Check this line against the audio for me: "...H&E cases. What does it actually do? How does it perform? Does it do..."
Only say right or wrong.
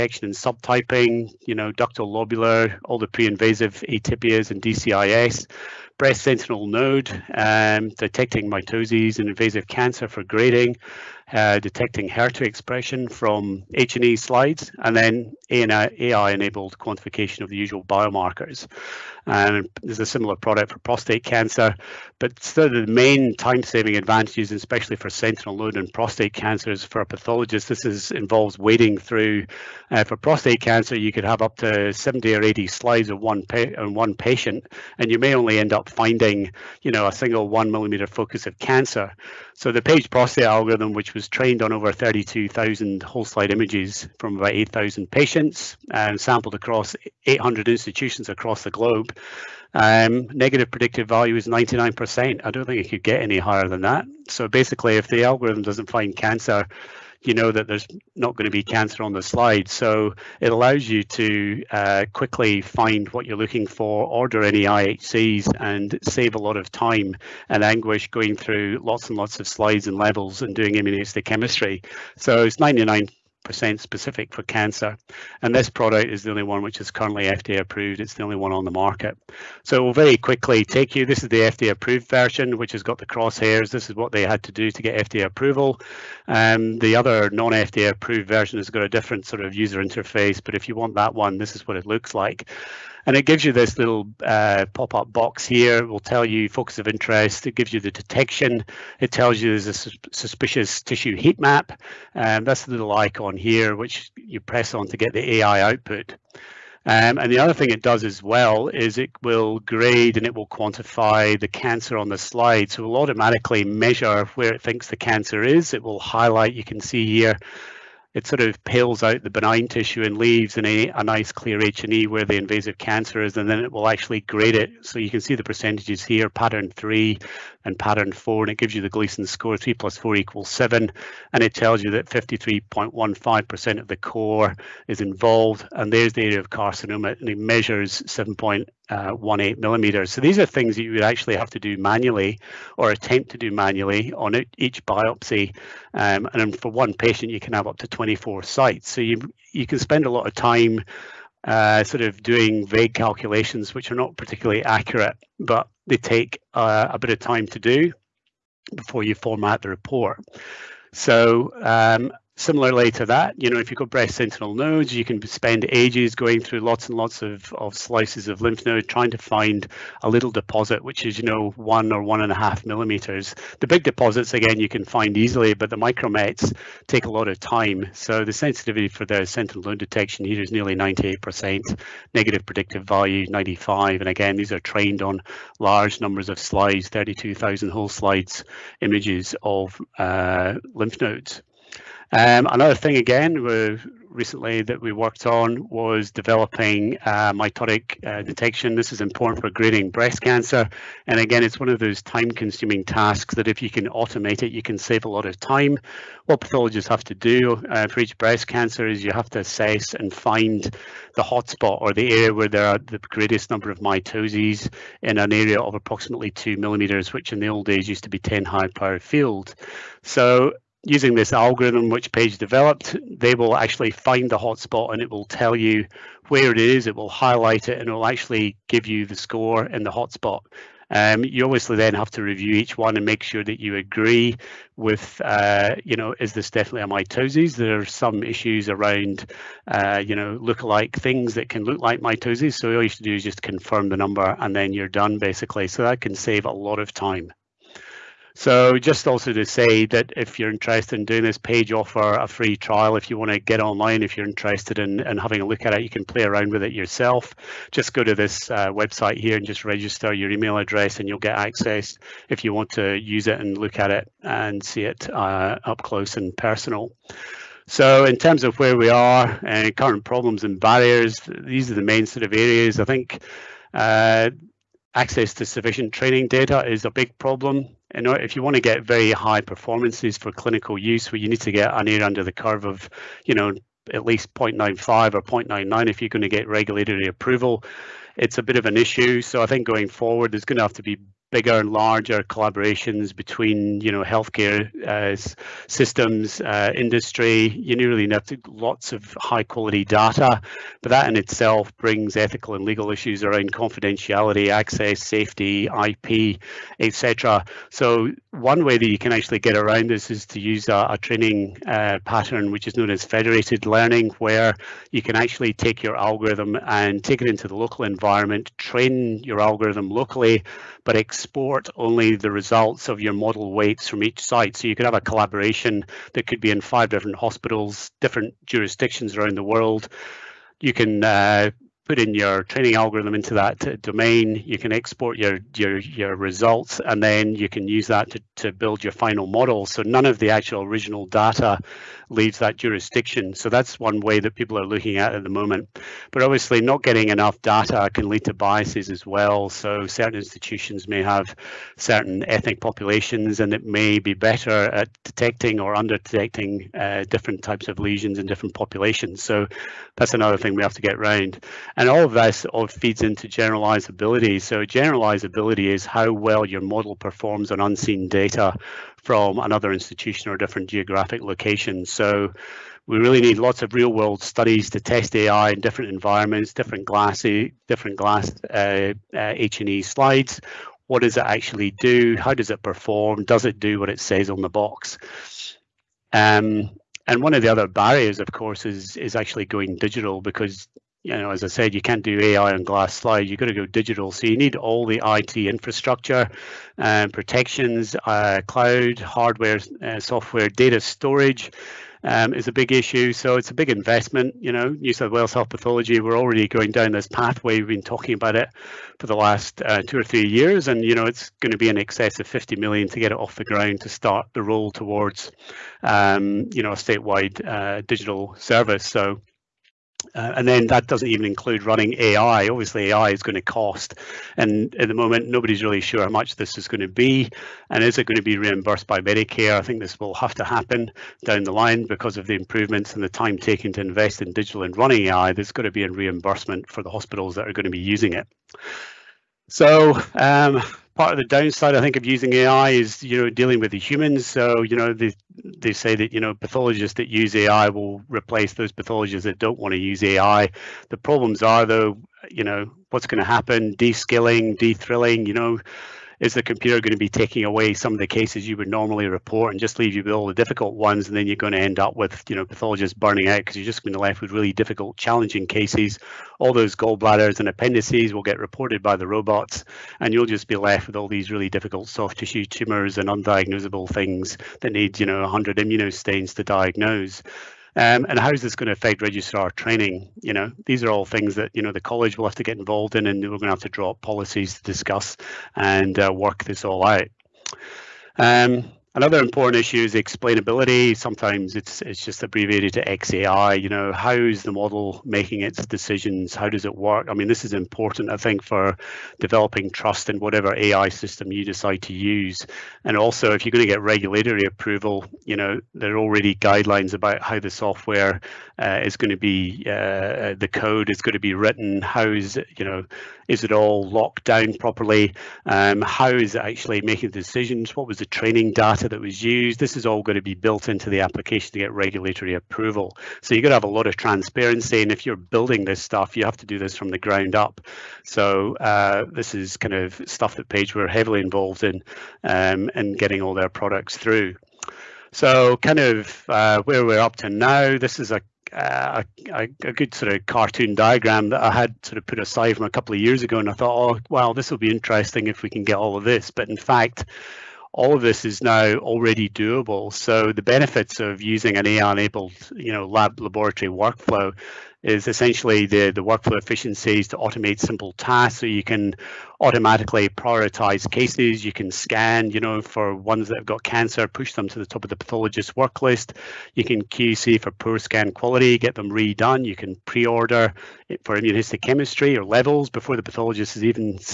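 wrong.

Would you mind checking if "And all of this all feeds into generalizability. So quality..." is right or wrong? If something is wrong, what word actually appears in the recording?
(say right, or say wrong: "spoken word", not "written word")
wrong: "generalizability", not "quality".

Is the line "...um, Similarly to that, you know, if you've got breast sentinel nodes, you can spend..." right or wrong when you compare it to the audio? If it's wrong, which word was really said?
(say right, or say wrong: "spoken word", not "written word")
right.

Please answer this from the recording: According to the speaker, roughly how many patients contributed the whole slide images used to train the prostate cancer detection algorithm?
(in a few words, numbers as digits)
8,000.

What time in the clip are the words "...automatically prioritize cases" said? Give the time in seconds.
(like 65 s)
559 s.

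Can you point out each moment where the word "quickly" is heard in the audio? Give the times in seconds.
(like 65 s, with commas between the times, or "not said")
62 s, 80 s.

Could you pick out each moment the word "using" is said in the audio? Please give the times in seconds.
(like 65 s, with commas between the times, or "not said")
220 s, 437 s, 442 s, 551 s.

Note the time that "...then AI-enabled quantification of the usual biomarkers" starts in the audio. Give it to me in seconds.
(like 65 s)
14 s.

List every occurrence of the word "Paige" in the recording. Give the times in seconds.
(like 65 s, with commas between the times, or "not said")
39 s, 222 s, 251 s, 530 s.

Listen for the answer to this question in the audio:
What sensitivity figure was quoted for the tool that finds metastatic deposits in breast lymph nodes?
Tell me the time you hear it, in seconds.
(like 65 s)
180 s.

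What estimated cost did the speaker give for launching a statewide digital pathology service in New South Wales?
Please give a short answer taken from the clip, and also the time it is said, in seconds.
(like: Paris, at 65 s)
over 50 million, at 411 s.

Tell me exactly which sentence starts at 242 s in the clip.
So all you should do is just confirm the number and then you're done basically.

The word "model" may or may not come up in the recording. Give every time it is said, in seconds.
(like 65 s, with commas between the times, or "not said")
323 s, 339 s, 366 s, 494 s.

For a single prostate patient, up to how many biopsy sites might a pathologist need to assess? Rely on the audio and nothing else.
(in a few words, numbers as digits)
24.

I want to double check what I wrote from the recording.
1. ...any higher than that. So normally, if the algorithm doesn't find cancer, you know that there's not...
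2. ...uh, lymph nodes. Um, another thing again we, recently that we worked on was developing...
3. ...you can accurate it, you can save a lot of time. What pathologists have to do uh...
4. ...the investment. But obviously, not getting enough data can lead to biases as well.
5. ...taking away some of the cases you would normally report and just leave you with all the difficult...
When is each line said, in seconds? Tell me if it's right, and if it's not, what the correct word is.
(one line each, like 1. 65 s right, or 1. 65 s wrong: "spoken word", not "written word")
1. 53 s wrong: "basically", not "normally"
2. 189 s right
3. 203 s wrong: "automate", not "accurate"
4. 345 s wrong: "moment", not "investment"
5. 457 s right.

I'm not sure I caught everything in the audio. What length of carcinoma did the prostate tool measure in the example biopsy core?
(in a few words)
1.8 millimeters.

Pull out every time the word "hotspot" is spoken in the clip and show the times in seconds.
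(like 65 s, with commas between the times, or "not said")
211 s, 224 s, 229 s.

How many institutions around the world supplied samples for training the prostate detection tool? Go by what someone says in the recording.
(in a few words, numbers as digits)
800.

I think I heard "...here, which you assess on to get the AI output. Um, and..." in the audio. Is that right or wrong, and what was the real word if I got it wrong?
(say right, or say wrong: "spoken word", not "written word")
wrong: "press", not "assess".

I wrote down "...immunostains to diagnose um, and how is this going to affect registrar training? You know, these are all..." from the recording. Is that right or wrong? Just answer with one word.
right.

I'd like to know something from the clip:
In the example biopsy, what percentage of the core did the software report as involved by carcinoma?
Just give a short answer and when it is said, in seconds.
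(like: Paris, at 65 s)
53.15%, at 132 s.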